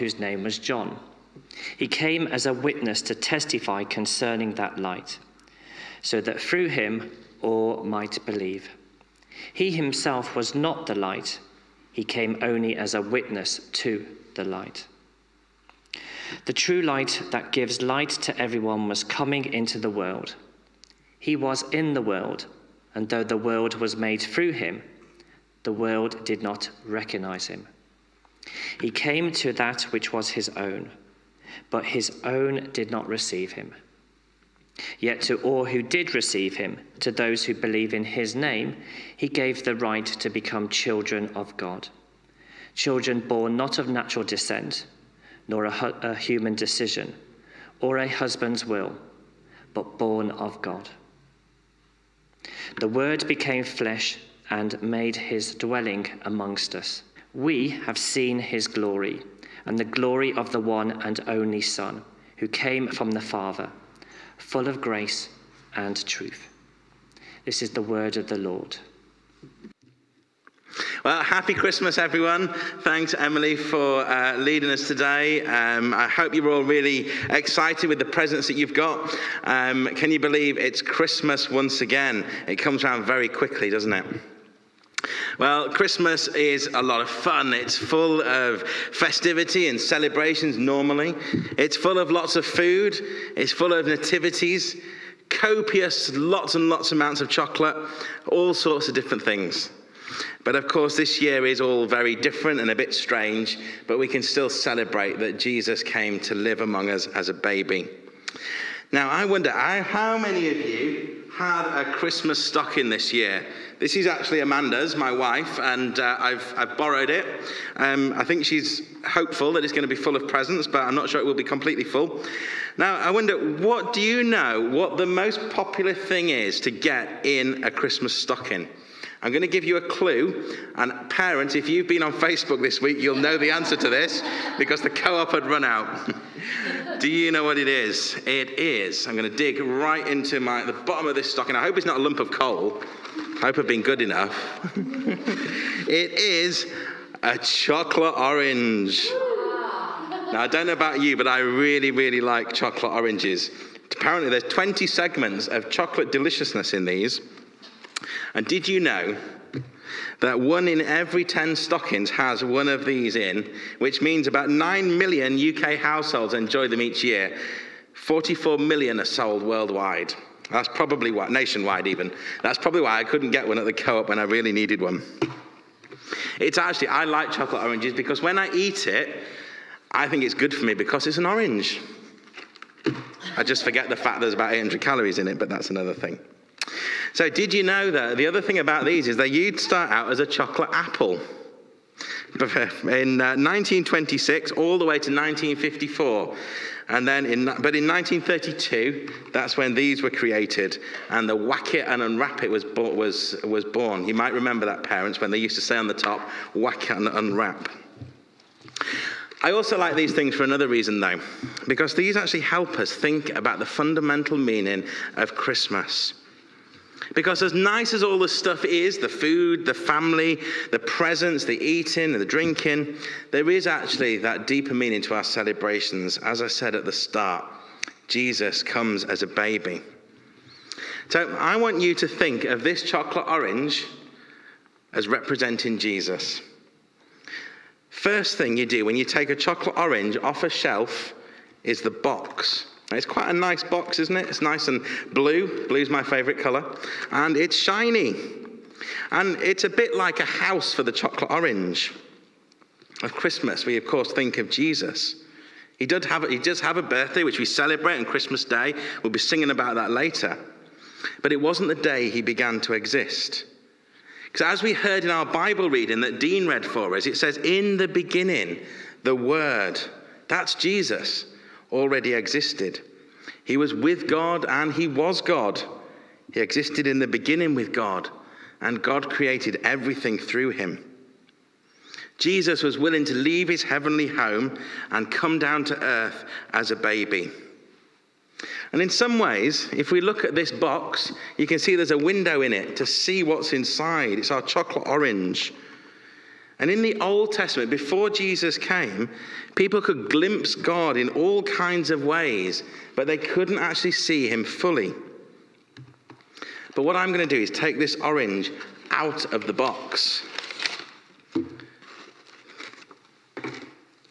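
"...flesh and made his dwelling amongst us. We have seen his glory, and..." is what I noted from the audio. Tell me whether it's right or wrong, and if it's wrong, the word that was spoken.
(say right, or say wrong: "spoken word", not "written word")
right.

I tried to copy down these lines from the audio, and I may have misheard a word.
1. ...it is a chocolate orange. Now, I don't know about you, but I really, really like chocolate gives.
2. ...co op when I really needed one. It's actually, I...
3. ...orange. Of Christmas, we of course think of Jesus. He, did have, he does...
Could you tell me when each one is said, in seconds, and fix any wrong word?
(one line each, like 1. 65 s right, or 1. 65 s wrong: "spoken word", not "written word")
1. 144 s wrong: "oranges", not "gives"
2. 173 s right
3. 251 s right.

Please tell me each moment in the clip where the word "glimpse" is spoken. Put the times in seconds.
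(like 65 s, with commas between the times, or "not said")
300 s.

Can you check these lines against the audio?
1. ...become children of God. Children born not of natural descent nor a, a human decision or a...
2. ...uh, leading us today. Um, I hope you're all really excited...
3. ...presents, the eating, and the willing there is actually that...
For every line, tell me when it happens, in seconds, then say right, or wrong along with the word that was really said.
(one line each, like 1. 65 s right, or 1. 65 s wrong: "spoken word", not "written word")
1. 40 s right
2. 74 s right
3. 220 s wrong: "drinking", not "willing".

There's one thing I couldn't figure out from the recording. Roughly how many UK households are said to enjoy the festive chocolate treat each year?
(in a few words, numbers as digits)
9 million.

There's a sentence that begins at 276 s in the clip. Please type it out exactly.
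He existed in the beginning with God, and God created everything through him.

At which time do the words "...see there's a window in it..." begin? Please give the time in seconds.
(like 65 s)
291 s.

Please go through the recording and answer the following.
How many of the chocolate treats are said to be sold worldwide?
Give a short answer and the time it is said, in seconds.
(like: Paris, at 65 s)
44 million, at 167 s.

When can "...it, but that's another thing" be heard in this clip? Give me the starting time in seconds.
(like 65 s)
185 s.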